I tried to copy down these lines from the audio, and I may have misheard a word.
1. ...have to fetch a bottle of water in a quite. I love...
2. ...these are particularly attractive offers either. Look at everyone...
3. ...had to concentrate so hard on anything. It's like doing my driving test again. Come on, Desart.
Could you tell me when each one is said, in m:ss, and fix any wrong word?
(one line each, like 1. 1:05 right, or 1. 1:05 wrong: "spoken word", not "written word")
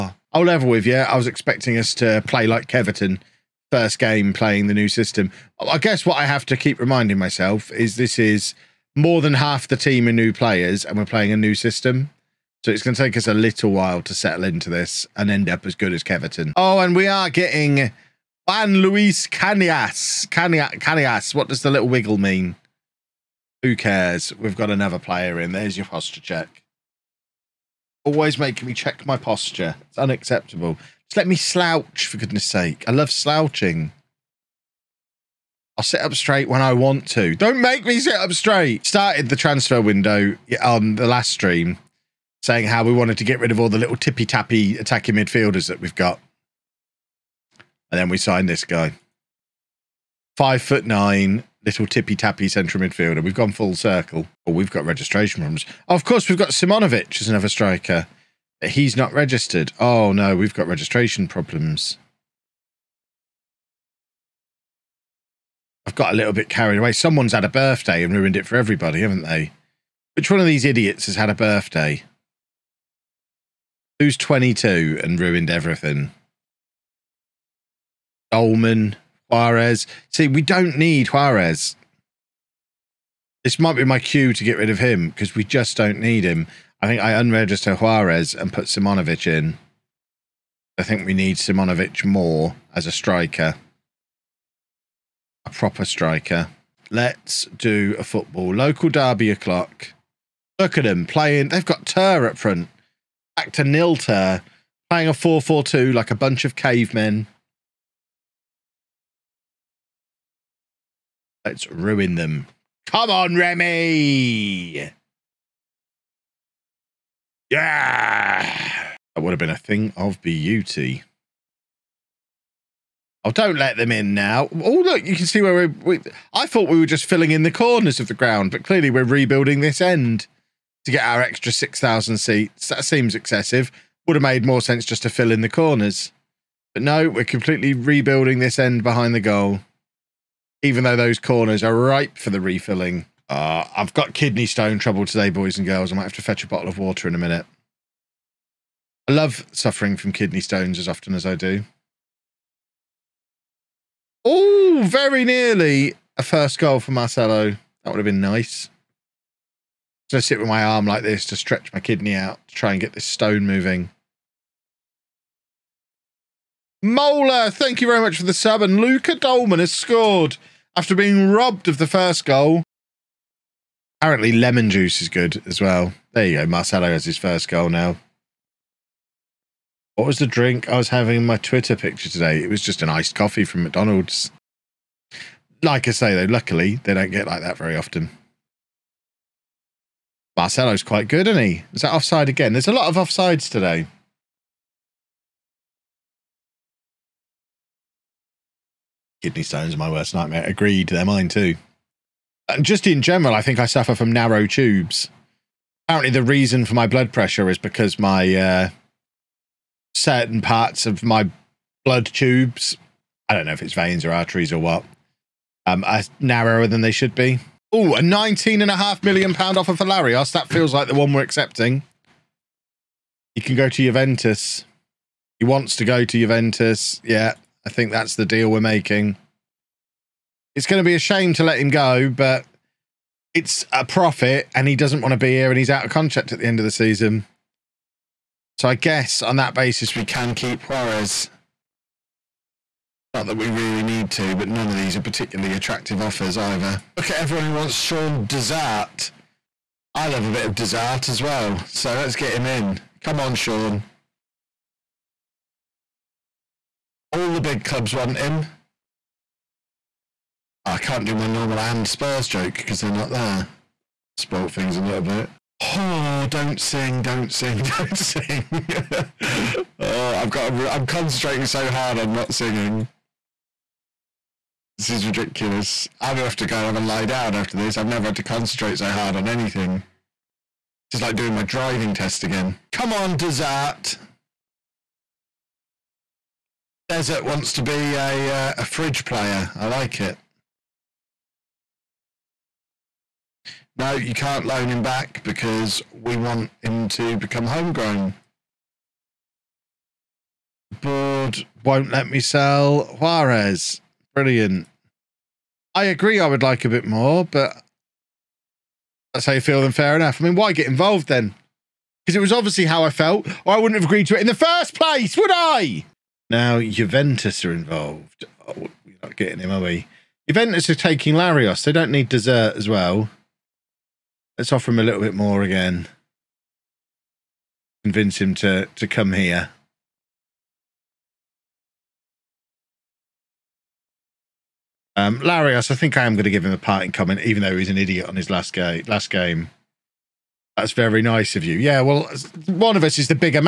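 1. 2:26 wrong: "minute", not "quite"
2. 4:04 right
3. 4:38 right.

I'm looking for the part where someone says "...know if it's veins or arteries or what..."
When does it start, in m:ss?
3:33.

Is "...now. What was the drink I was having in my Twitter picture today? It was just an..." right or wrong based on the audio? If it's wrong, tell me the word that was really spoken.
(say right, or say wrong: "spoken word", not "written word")
right.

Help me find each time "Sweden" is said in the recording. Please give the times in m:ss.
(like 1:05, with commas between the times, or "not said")
not said.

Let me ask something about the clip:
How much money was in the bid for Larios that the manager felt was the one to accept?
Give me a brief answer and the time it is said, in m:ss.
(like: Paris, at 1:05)
19.5 million pounds, at 3:38.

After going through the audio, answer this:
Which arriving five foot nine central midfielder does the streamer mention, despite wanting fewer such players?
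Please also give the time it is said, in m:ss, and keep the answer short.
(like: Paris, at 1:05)
Juan Luis Canias, at 0:18.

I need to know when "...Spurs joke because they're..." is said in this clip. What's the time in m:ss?
4:21.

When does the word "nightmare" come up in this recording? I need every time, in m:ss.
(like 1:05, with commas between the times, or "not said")
3:20.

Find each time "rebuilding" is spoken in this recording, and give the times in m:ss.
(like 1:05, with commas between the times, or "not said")
2:09, 2:17.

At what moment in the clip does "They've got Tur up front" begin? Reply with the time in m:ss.
1:41.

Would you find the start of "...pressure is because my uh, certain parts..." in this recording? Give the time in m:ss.
3:27.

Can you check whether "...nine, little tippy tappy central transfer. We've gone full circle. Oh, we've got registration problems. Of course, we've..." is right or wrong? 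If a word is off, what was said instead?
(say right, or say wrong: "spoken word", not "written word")
wrong: "midfielder", not "transfer".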